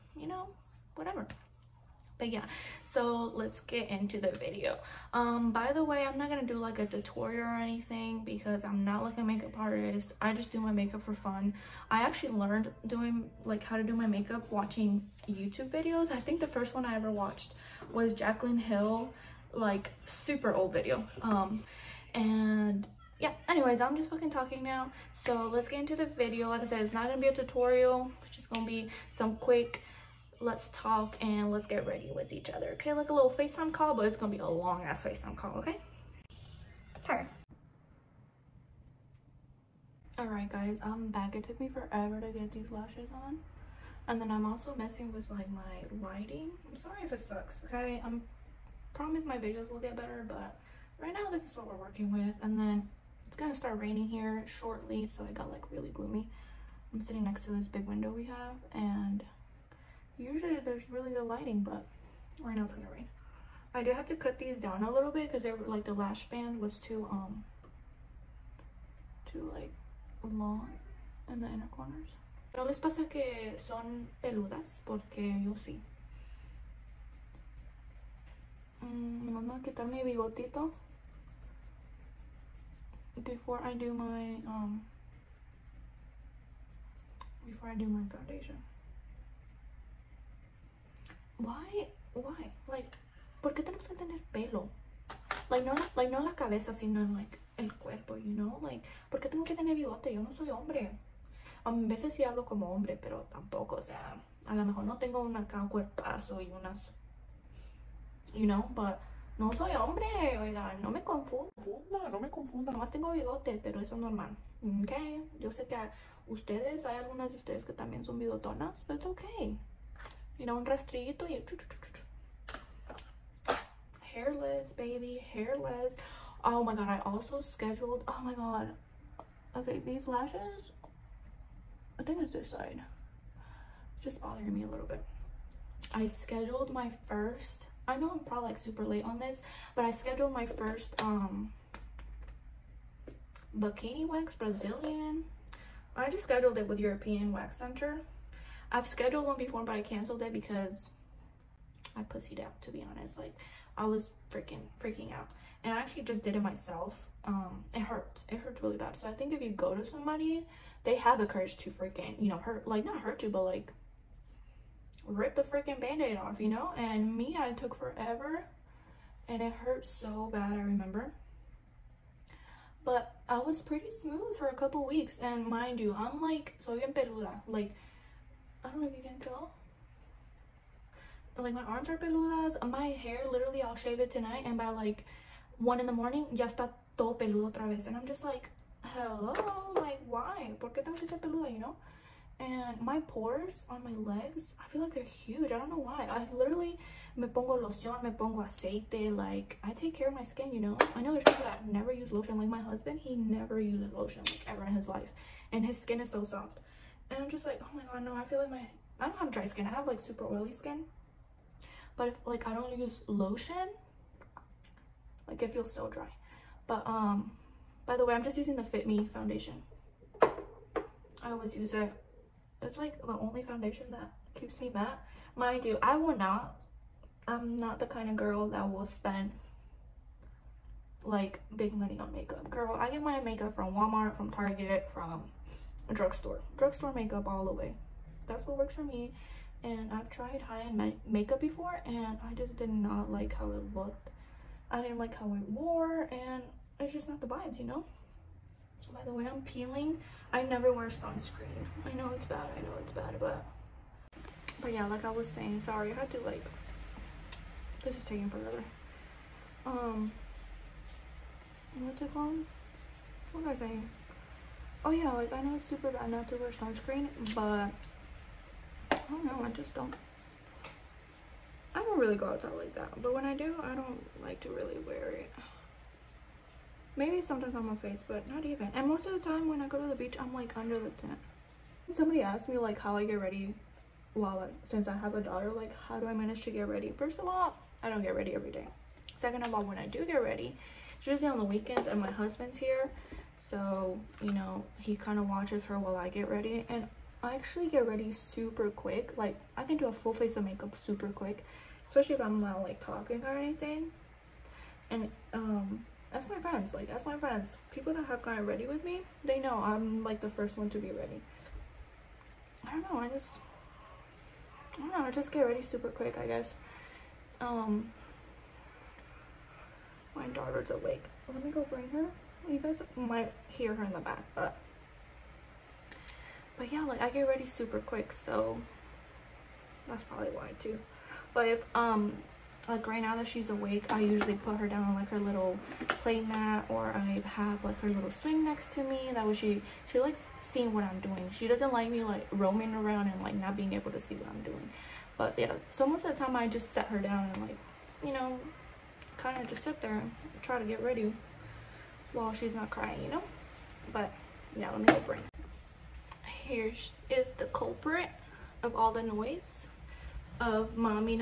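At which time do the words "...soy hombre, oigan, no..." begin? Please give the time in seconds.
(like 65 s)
109 s.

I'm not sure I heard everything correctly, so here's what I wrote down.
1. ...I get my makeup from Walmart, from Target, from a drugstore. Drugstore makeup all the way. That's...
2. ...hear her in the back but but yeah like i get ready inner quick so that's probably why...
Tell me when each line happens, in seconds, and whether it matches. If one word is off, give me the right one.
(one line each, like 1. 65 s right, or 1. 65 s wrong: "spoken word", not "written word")
1. 232 s right
2. 323 s wrong: "super", not "inner".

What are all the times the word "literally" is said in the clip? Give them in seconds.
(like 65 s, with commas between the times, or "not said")
183 s, 196 s.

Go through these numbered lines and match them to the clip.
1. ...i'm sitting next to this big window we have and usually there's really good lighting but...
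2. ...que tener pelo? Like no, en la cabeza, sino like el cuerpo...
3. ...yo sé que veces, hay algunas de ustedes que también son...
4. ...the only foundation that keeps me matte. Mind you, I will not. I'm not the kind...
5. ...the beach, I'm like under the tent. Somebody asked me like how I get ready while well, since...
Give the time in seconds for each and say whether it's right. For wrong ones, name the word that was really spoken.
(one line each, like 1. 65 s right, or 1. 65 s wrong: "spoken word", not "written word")
1. 56 s right
2. 93 s right
3. 115 s wrong: "ustedes", not "veces"
4. 223 s right
5. 279 s right.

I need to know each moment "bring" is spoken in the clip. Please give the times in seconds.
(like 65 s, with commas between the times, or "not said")
321 s, 355 s.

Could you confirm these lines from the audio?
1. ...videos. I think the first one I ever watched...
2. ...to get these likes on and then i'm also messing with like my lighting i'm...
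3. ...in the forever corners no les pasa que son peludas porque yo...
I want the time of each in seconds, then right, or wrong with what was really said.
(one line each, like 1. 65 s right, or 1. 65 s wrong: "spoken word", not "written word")
1. 15 s right
2. 42 s wrong: "lashes", not "likes"
3. 71 s wrong: "inner", not "forever".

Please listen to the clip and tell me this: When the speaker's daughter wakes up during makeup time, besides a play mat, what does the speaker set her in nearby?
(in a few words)
swing.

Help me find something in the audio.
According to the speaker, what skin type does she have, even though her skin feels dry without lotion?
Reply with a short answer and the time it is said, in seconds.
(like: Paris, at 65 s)
super oily, at 210 s.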